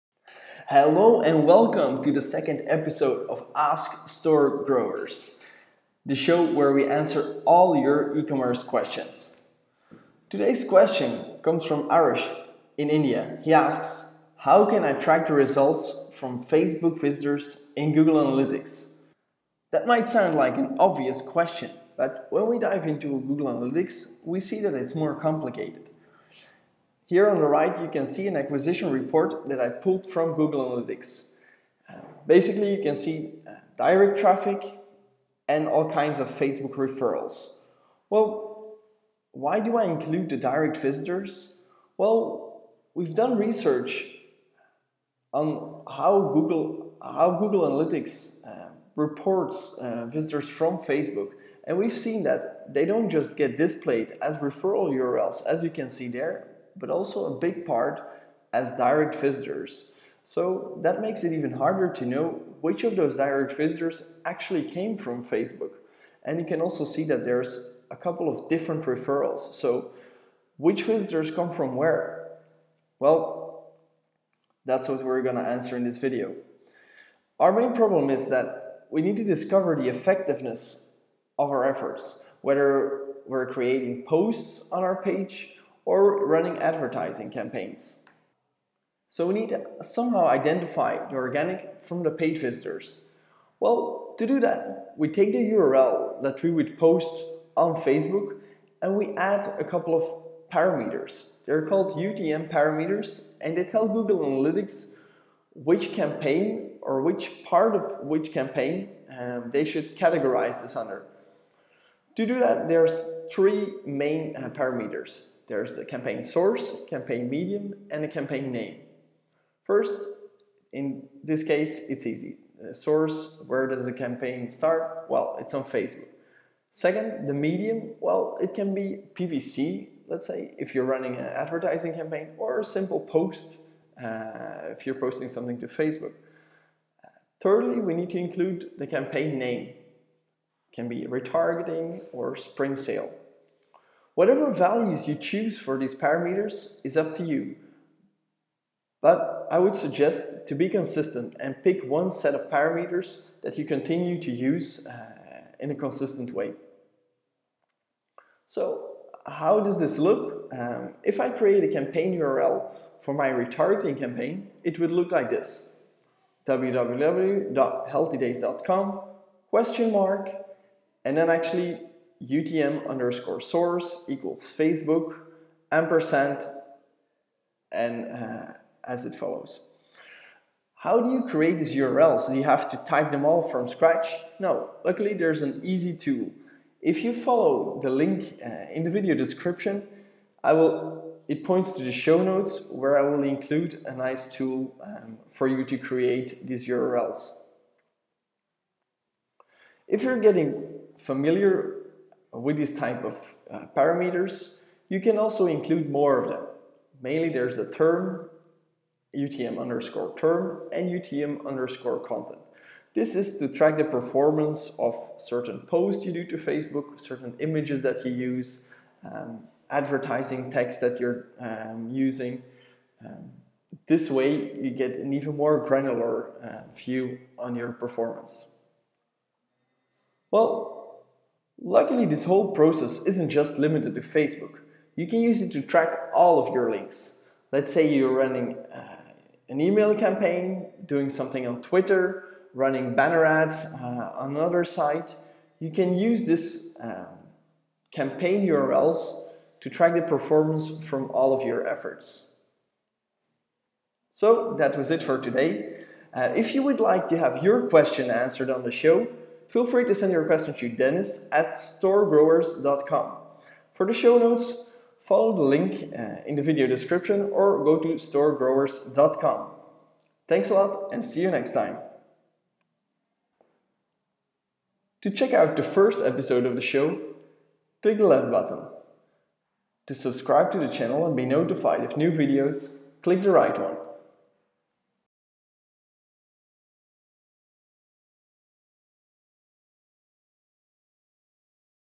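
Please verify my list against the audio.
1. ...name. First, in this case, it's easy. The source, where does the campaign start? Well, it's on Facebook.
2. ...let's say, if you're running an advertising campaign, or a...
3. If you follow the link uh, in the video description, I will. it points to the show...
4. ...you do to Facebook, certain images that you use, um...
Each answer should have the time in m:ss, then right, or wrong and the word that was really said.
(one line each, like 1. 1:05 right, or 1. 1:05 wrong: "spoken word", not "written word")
1. 1:58 right
2. 2:10 right
3. 3:06 right
4. 3:36 right.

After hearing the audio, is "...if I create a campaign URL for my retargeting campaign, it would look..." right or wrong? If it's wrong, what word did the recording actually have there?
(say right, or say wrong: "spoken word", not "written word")
right.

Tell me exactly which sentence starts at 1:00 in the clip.
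So that makes it even harder to know which of those direct visitors actually came from Facebook.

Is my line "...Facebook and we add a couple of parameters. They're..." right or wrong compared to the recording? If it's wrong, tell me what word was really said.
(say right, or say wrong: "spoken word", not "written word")
right.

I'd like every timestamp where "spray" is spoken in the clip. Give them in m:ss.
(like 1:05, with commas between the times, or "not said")
not said.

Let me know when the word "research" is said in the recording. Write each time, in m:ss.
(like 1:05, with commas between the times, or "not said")
0:43.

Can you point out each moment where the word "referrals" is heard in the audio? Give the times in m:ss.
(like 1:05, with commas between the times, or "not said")
0:36, 0:54, 1:08.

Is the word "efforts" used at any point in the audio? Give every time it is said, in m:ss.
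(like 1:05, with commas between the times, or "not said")
1:21, 4:11.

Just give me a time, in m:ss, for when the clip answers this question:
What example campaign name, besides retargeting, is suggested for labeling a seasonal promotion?
2:22.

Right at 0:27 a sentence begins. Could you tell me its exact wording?
Here on the right, you can see an acquisition report that I pulled from Google Analytics.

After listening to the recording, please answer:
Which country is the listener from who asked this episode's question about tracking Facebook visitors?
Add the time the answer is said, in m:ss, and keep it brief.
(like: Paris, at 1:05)
India, at 0:12.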